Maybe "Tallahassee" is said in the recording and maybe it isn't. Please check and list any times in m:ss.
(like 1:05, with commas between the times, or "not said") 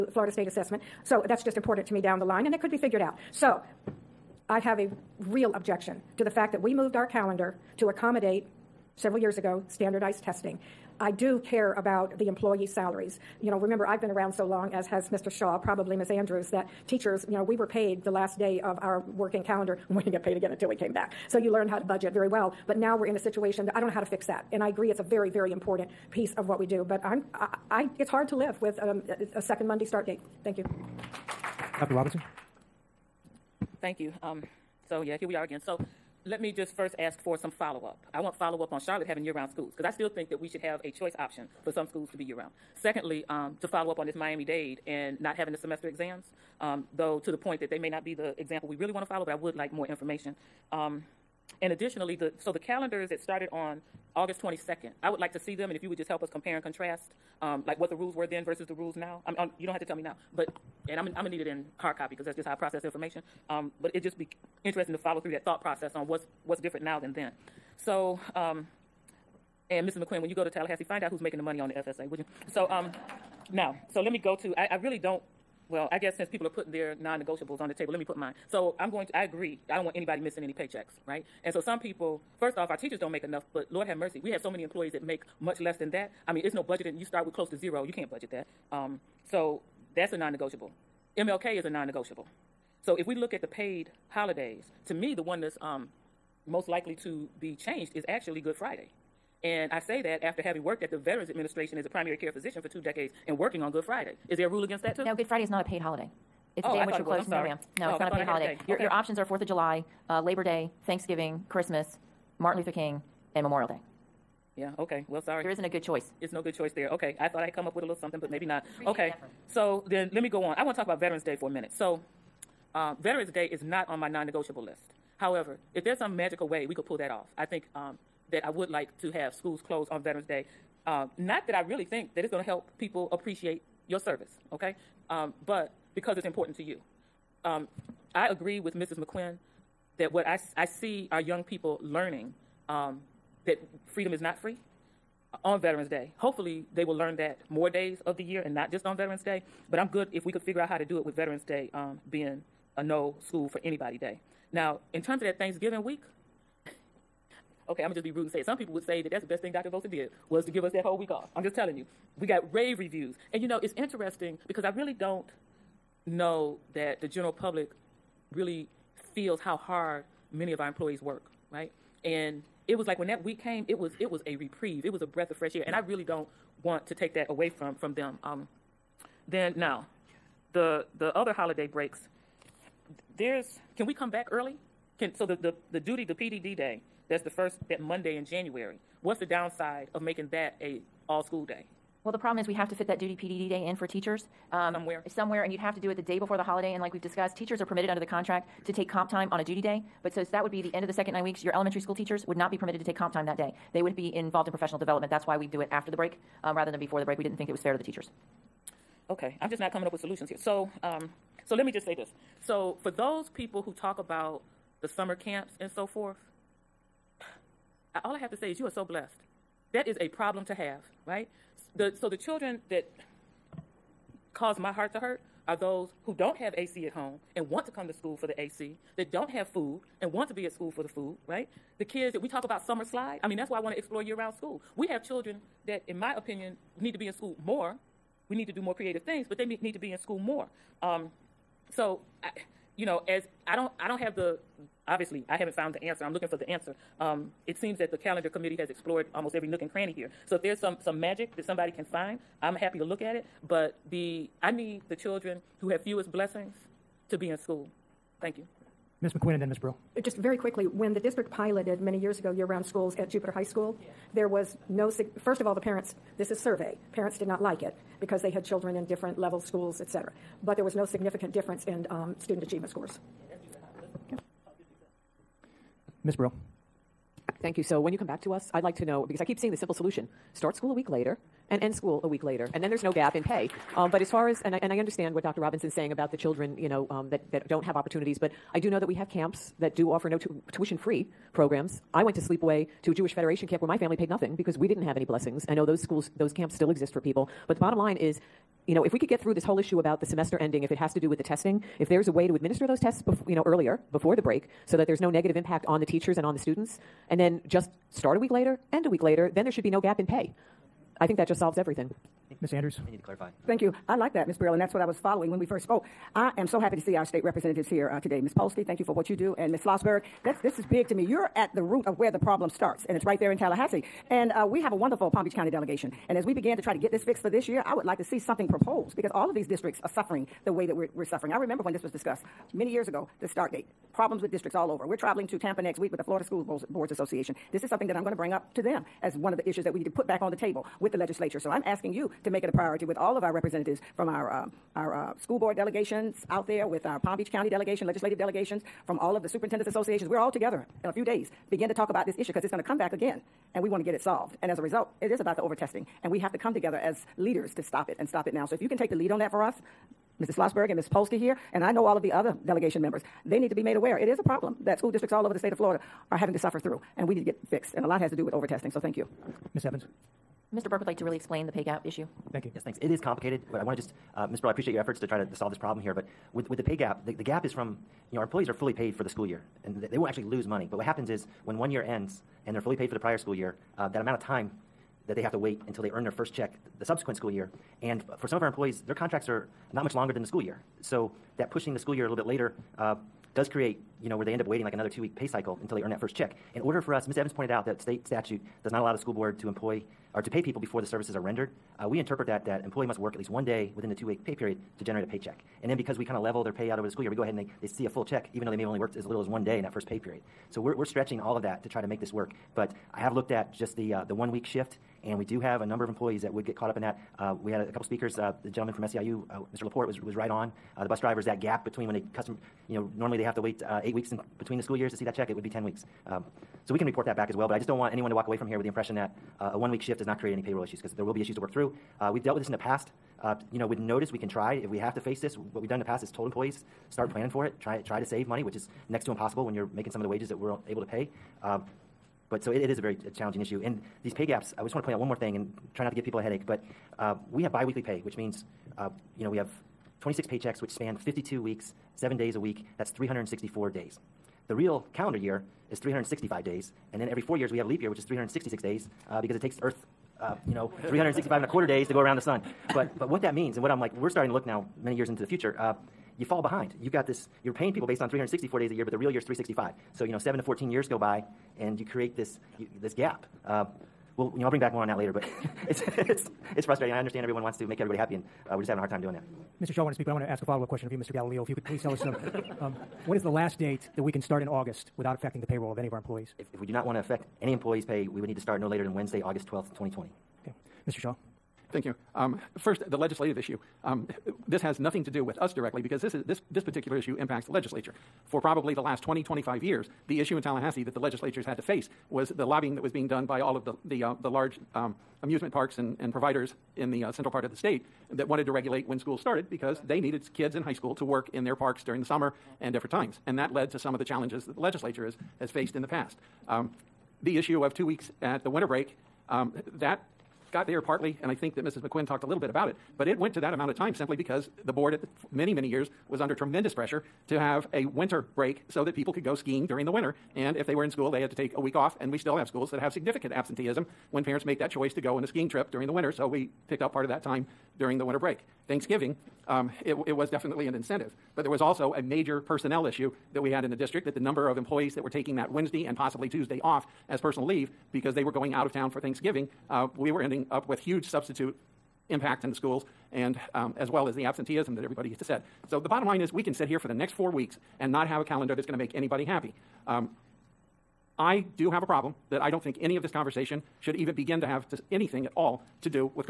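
1:10, 5:23, 8:20.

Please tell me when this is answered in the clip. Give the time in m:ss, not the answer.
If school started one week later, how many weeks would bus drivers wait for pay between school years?
7:05.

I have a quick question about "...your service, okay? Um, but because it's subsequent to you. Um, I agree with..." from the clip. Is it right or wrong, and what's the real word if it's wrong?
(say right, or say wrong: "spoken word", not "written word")
wrong: "important", not "subsequent".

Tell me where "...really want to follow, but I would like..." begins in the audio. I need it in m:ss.
0:48.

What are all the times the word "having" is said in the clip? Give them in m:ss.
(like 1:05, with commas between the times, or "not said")
0:39, 0:45, 1:40, 6:06, 7:58.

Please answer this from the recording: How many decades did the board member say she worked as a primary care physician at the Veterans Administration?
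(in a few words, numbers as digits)
2.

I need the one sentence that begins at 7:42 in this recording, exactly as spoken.
But, but what that means, and what I'm like, we're starting to look now many years into the future.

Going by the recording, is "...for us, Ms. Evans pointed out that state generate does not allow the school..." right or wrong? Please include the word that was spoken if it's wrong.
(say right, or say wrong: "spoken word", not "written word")
wrong: "statute", not "generate".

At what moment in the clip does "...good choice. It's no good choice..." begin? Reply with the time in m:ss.
1:55.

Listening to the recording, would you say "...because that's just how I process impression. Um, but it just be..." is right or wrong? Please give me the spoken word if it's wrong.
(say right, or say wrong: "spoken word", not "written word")
wrong: "information", not "impression".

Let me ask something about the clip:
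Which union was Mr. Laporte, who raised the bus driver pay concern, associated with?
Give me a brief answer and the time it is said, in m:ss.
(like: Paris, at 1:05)
SEIU, at 6:58.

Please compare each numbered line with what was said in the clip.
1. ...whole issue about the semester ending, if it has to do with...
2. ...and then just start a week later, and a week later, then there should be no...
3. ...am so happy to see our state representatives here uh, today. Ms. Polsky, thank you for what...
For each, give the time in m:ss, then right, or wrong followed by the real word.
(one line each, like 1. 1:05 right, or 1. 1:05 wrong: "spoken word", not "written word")
1. 4:59 right
2. 5:07 right
3. 5:16 right.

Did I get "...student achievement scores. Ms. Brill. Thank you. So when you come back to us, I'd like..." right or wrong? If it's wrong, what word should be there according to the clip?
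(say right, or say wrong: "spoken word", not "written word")
right.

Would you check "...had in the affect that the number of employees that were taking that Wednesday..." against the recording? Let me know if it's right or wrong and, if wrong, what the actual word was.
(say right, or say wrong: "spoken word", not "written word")
wrong: "district", not "affect".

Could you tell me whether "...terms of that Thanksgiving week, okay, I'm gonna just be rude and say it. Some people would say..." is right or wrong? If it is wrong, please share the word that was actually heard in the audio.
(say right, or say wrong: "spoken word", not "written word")
right.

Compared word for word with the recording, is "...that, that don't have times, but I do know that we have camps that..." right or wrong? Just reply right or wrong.
wrong.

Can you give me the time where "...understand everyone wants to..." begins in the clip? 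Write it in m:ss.
7:56.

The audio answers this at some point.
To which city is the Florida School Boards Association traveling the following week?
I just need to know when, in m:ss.
5:35.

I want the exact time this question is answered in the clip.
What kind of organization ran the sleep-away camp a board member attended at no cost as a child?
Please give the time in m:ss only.
4:52.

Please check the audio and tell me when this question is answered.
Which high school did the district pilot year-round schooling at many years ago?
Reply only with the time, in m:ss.
4:23.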